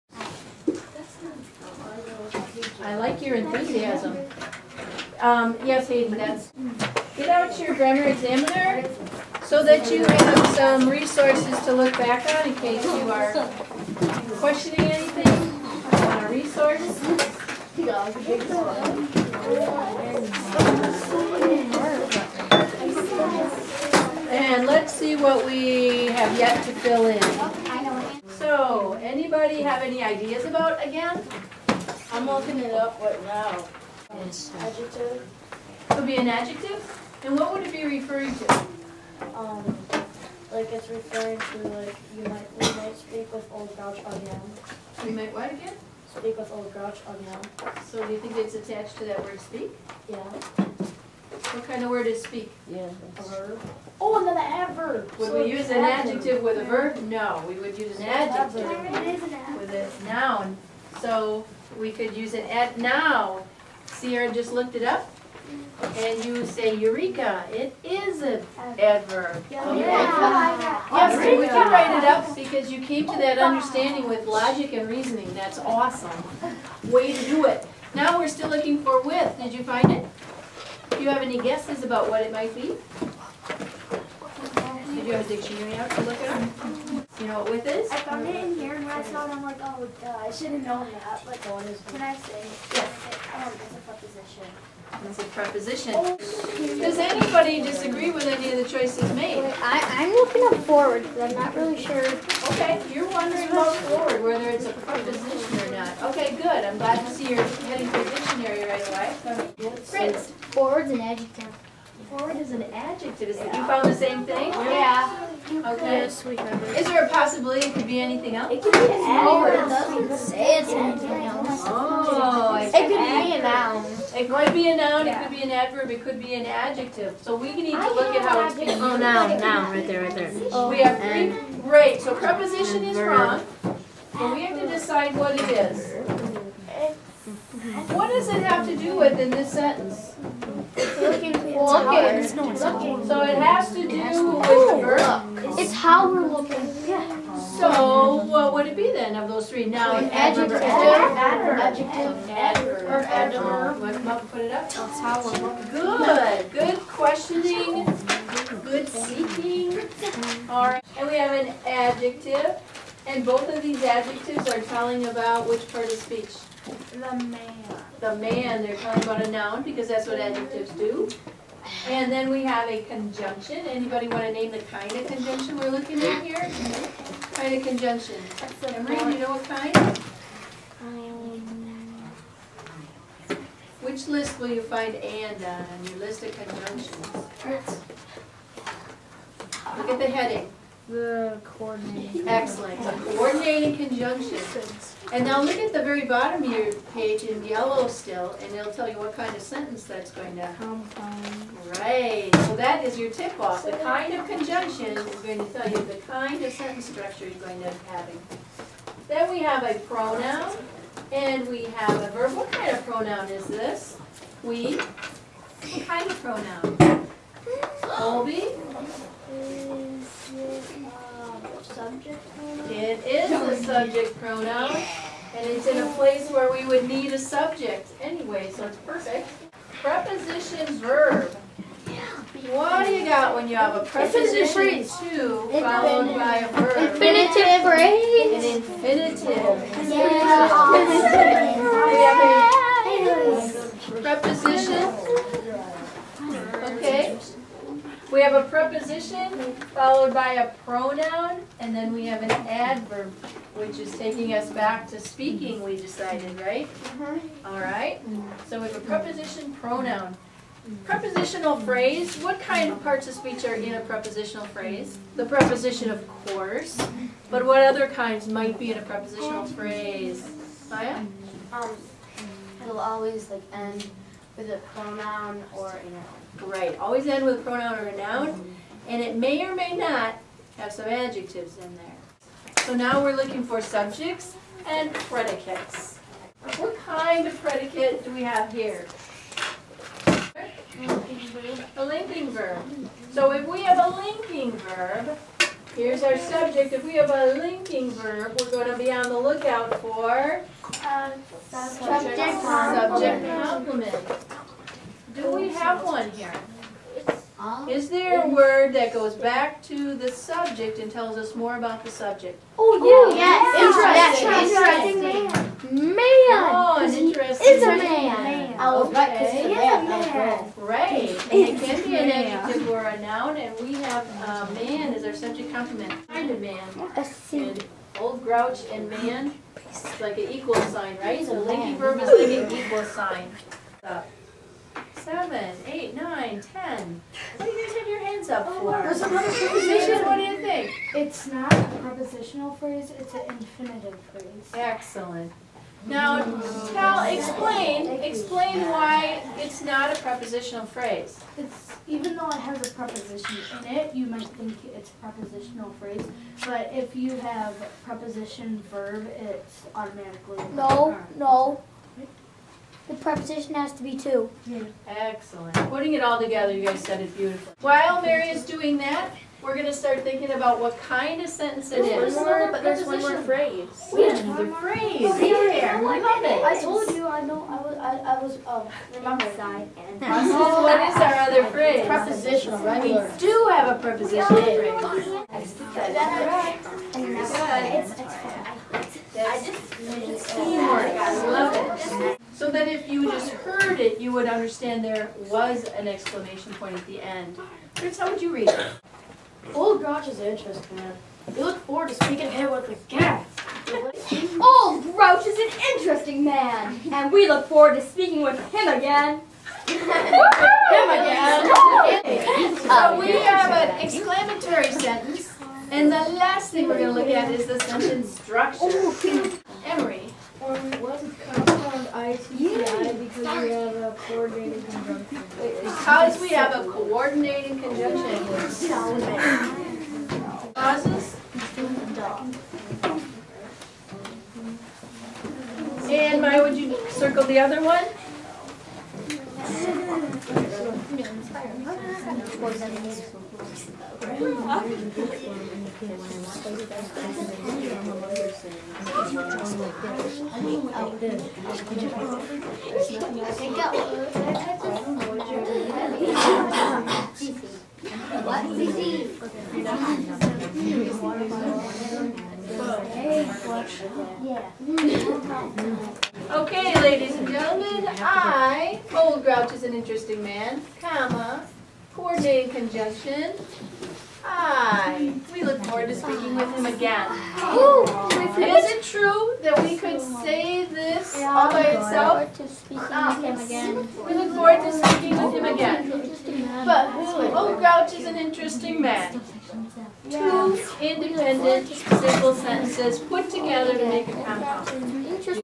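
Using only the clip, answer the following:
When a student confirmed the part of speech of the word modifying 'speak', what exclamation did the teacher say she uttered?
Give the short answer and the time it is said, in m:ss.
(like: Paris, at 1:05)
Eureka, at 1:06.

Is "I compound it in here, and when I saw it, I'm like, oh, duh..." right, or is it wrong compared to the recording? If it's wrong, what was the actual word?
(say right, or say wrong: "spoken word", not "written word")
wrong: "found", not "compound".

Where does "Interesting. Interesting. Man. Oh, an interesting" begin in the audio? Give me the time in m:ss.
5:15.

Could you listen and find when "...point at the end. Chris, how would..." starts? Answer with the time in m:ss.
6:36.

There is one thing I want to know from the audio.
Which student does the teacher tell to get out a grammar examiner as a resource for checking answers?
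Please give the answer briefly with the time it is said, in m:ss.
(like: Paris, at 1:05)
Hayden, at 0:05.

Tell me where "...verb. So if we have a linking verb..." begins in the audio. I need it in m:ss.
4:52.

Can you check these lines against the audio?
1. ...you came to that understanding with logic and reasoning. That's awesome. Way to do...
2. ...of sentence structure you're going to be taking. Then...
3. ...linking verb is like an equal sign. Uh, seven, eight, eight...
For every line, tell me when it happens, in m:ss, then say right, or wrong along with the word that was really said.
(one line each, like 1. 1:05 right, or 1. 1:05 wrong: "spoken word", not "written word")
1. 1:12 right
2. 3:26 wrong: "having", not "taking"
3. 5:31 wrong: "nine", not "eight".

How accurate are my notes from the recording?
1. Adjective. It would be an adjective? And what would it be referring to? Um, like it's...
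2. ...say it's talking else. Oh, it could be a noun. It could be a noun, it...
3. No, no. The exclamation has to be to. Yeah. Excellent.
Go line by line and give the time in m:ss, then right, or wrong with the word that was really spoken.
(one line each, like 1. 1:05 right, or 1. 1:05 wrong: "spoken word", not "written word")
1. 0:34 right
2. 2:00 wrong: "anything", not "talking"
3. 6:00 wrong: "preposition", not "exclamation".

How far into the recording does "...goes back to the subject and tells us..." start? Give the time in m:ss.
5:08.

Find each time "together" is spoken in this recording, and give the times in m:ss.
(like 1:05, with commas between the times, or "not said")
6:06, 8:13.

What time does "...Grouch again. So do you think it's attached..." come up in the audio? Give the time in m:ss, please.
0:46.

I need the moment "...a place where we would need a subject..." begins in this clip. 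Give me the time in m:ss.
3:45.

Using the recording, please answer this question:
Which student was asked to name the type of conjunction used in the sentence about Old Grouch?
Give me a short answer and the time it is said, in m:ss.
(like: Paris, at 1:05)
Emery, at 2:58.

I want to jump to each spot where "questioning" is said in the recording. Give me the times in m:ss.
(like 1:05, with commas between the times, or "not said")
0:14, 2:36.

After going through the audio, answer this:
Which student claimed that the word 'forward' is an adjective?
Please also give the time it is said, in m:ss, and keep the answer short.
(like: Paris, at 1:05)
Fritz, at 1:49.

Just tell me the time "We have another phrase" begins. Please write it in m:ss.
6:13.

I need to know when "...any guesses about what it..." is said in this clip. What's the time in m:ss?
1:21.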